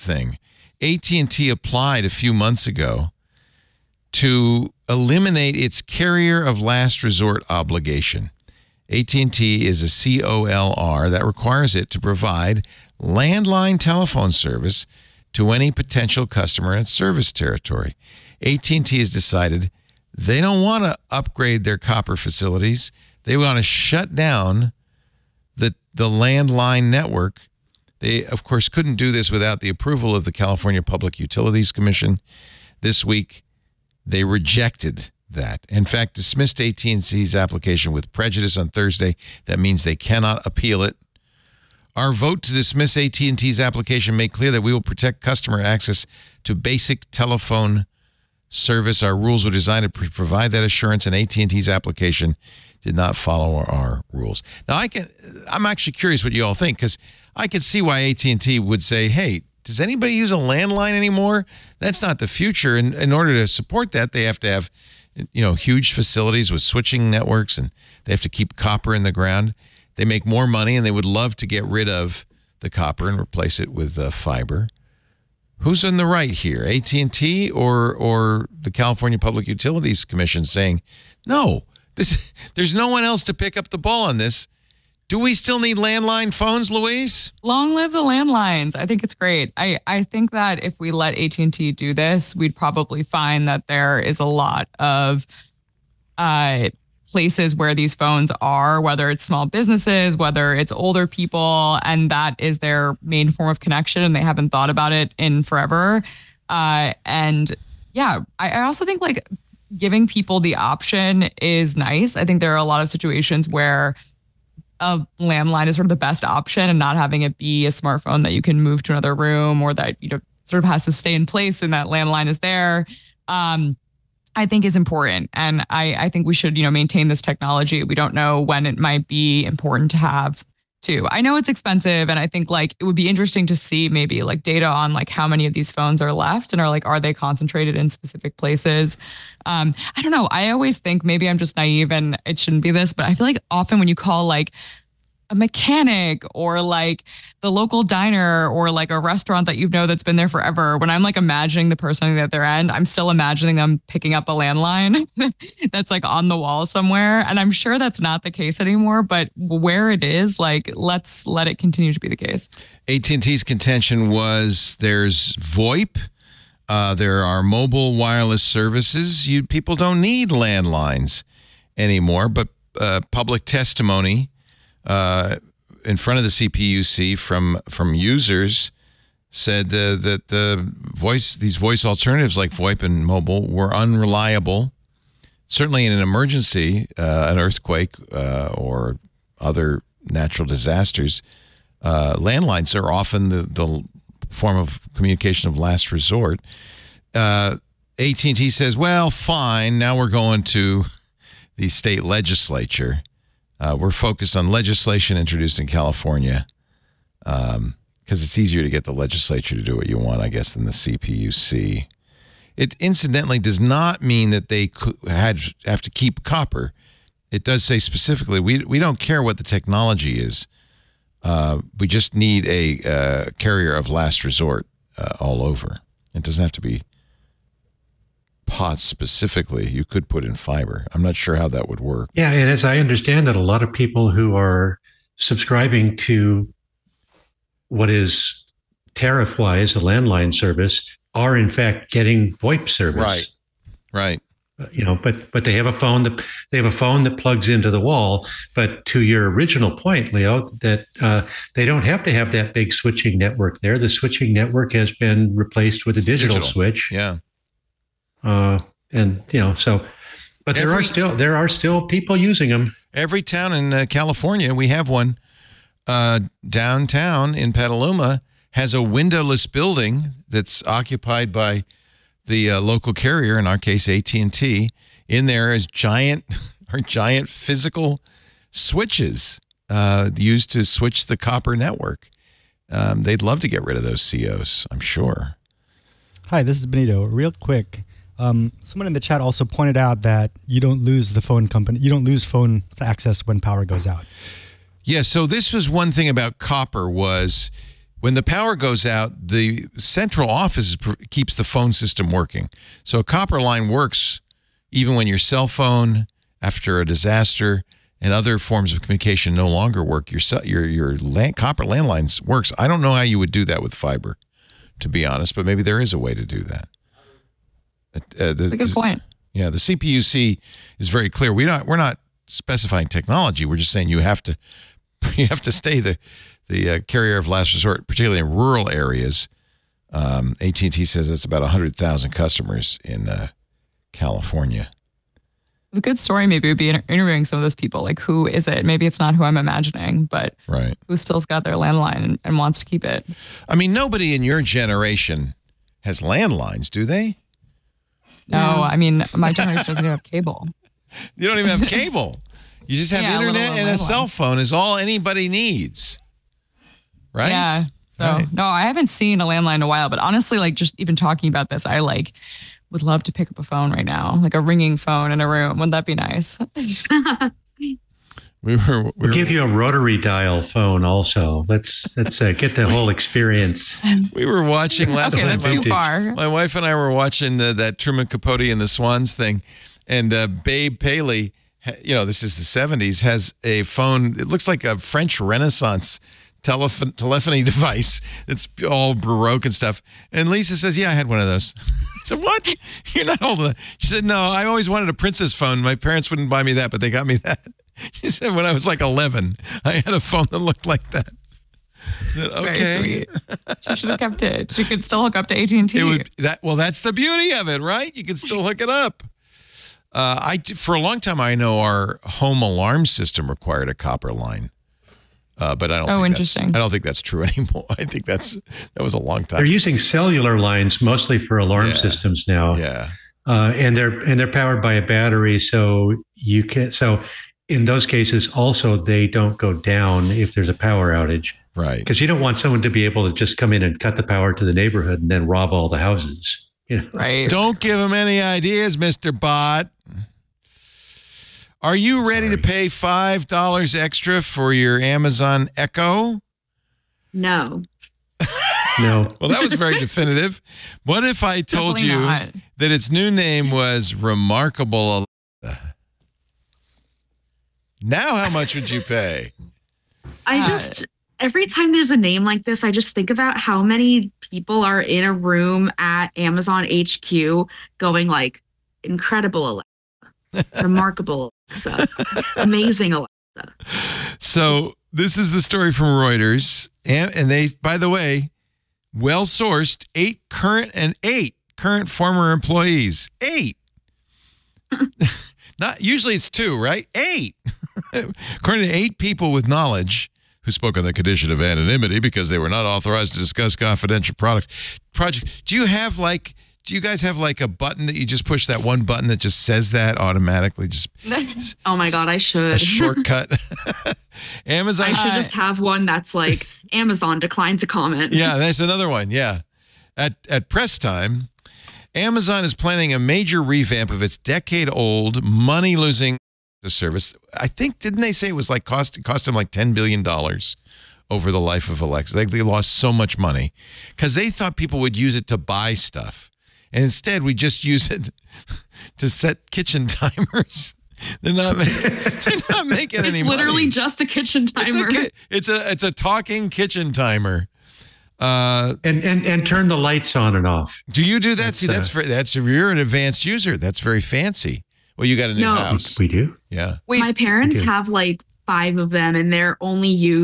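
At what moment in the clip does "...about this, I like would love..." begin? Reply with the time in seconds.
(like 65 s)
361 s.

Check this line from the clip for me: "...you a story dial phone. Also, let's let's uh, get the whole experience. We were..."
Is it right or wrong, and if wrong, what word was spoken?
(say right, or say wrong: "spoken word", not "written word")
wrong: "rotary", not "story".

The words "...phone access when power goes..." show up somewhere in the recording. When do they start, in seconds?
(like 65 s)
292 s.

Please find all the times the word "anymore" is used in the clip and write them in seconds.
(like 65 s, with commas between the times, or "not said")
60 s, 158 s, 171 s, 417 s.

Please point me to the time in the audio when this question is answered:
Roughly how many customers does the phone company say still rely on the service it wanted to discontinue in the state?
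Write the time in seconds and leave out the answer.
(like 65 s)
331 s.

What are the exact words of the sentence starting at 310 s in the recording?
Your your your land, copper landlines works.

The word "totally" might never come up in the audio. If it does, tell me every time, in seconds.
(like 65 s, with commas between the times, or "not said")
not said.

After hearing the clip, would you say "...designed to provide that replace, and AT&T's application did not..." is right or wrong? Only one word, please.
wrong.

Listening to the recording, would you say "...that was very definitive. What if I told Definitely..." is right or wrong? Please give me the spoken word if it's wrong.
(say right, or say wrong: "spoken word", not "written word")
right.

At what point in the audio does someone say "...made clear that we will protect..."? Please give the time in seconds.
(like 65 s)
44 s.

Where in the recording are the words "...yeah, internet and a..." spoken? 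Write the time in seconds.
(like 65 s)
353 s.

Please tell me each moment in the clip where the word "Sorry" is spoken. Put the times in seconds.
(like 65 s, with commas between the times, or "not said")
442 s.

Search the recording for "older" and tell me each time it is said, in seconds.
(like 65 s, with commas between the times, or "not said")
100 s.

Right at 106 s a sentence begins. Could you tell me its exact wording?
Uh, and yeah, I, I also think like giving people the option is nice.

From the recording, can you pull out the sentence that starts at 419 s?
They're using cellular lines mostly for alarm yeah.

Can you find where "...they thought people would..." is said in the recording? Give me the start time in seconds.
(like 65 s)
524 s.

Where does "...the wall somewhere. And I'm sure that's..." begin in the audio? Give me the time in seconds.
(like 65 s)
156 s.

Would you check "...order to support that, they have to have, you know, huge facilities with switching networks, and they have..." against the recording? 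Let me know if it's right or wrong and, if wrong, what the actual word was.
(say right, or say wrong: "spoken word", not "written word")
right.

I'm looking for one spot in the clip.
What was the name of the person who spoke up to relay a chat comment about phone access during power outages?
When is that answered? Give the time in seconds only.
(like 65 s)
286 s.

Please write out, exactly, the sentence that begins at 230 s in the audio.
I'm not sure how that would work.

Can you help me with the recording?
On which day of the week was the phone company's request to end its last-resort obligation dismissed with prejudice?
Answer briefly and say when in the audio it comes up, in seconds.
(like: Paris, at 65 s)
Thursday, at 38 s.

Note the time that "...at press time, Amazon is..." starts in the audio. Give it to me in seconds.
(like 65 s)
510 s.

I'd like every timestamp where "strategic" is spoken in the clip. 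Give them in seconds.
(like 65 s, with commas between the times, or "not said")
not said.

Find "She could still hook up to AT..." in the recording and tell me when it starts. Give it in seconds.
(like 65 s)
404 s.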